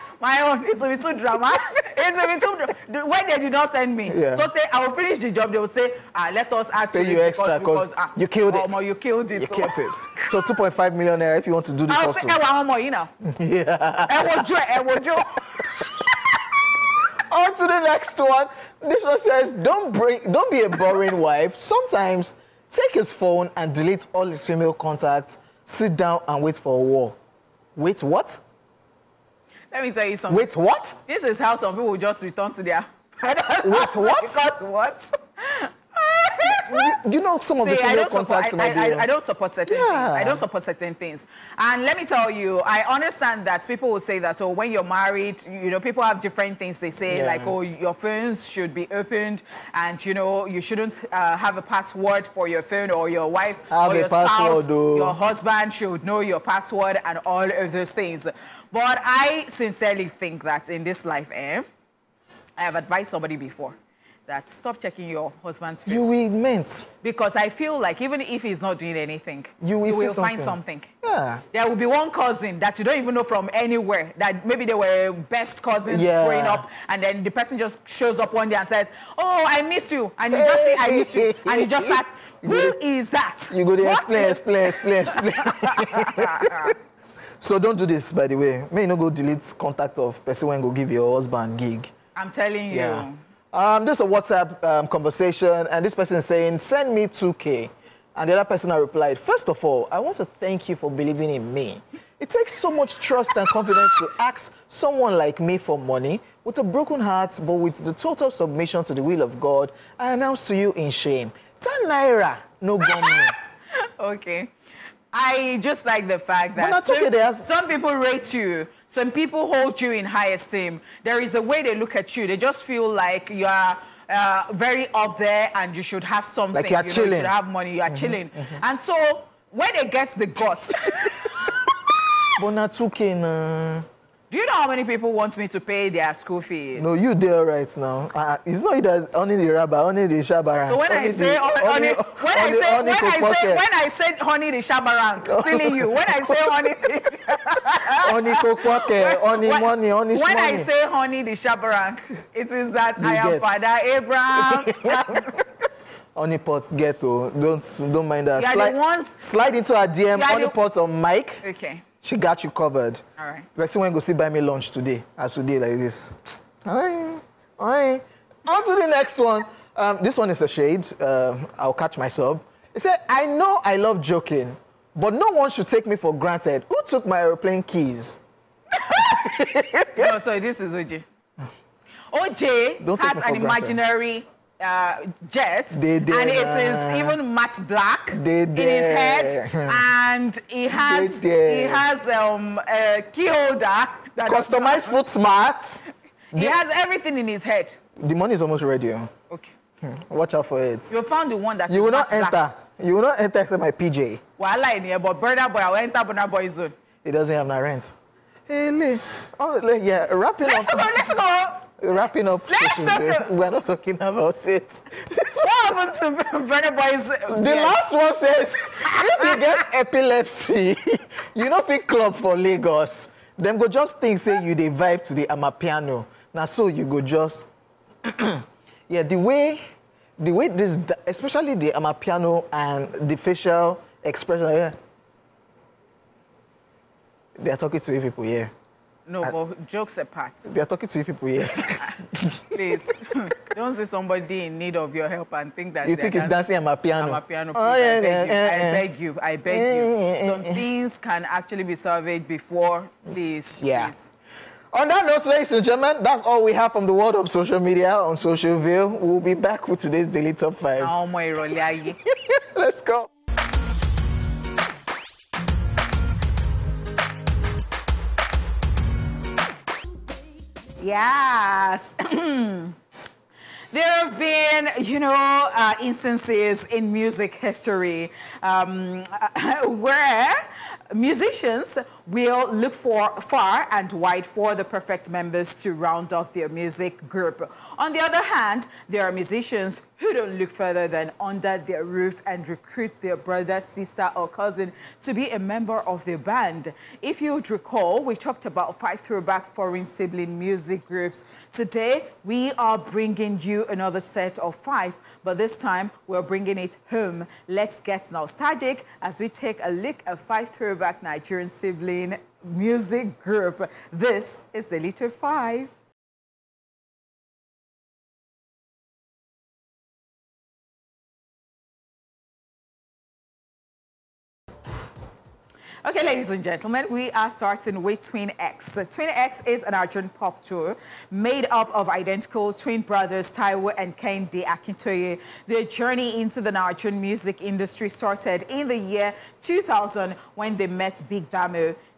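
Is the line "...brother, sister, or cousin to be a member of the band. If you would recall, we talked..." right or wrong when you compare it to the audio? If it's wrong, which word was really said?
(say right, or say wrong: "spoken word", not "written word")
right.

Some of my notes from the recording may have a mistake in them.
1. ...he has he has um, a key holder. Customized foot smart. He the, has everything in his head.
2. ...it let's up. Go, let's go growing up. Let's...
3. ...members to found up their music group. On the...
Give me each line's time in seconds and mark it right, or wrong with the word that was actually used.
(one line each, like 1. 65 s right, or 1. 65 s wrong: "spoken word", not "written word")
1. 190 s right
2. 210 s wrong: "wrapping", not "growing"
3. 285 s wrong: "round", not "found".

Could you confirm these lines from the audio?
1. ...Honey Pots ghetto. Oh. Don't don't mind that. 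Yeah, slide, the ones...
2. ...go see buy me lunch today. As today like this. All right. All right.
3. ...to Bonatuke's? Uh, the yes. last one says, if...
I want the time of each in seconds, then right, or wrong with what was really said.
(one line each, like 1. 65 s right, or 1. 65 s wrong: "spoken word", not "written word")
1. 156 s right
2. 163 s right
3. 216 s wrong: "Venaboy", not "Bonatuke".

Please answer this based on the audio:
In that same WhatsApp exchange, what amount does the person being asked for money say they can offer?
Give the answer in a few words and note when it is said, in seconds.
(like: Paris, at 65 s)
10 naira, at 111 s.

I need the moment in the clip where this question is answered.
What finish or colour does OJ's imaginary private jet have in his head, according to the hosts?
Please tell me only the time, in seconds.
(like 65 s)
187 s.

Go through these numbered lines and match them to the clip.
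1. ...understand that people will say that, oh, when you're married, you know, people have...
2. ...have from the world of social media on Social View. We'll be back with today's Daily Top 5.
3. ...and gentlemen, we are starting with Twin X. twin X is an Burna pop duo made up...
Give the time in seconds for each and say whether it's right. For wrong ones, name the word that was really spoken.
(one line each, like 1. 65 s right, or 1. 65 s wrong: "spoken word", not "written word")
1. 42 s right
2. 256 s right
3. 326 s wrong: "Argent", not "Burna".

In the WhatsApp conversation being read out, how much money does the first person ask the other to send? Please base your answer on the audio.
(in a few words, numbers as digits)
2K.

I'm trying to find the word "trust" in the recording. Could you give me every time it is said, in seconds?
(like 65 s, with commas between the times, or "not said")
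102 s.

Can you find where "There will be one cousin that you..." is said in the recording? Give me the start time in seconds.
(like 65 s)
71 s.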